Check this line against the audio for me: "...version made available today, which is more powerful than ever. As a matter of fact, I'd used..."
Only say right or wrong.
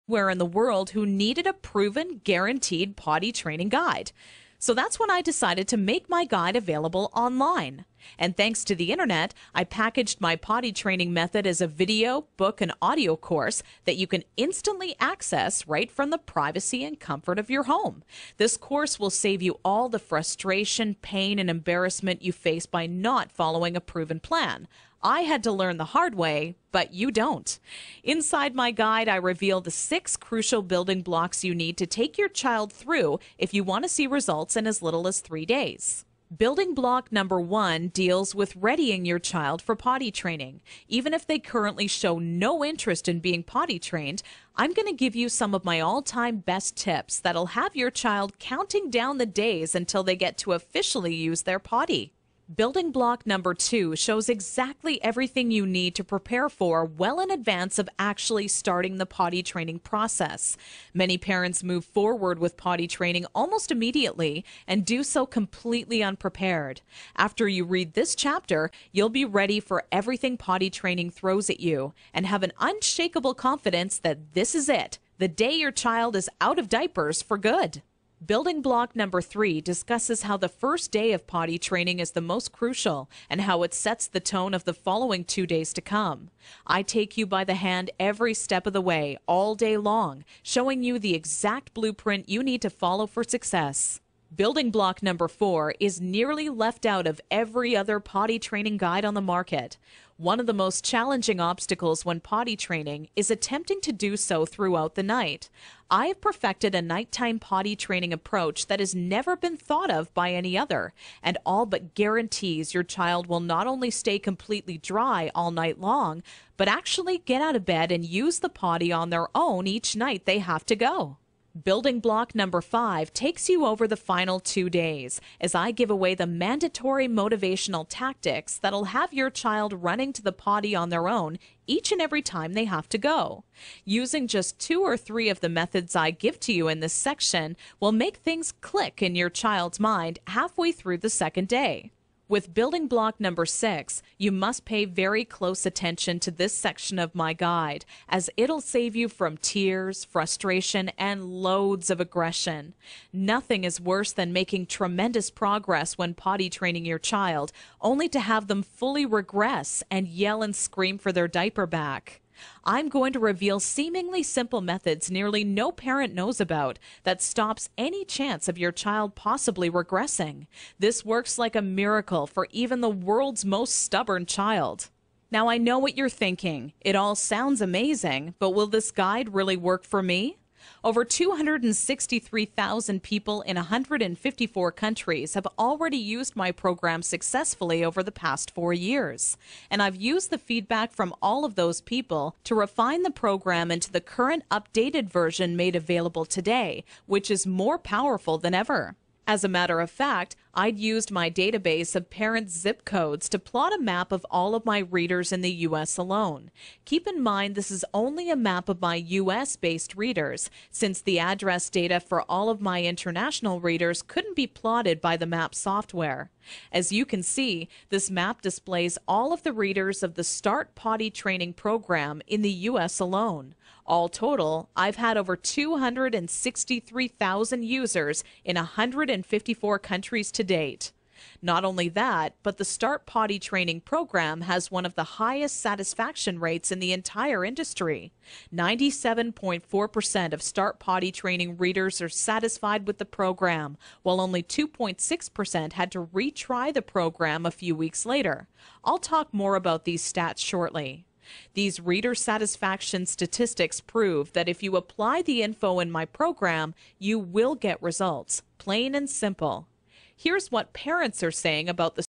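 right.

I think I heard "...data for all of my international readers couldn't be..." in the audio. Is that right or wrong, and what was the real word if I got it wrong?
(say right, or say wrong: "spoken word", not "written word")
right.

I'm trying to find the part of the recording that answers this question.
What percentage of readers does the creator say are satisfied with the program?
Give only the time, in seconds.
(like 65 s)
238 s.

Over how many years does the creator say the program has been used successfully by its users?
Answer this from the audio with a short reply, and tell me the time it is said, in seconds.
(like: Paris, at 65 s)
4, at 188 s.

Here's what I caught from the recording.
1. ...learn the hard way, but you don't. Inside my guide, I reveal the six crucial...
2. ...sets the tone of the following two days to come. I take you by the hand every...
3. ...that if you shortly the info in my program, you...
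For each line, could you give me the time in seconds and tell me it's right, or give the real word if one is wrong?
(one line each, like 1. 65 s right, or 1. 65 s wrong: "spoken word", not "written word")
1. 25 s right
2. 83 s right
3. 254 s wrong: "apply", not "shortly".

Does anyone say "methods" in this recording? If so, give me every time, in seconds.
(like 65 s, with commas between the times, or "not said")
11 s, 135 s, 164 s.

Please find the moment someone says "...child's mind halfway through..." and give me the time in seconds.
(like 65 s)
139 s.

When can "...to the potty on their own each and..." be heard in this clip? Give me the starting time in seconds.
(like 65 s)
130 s.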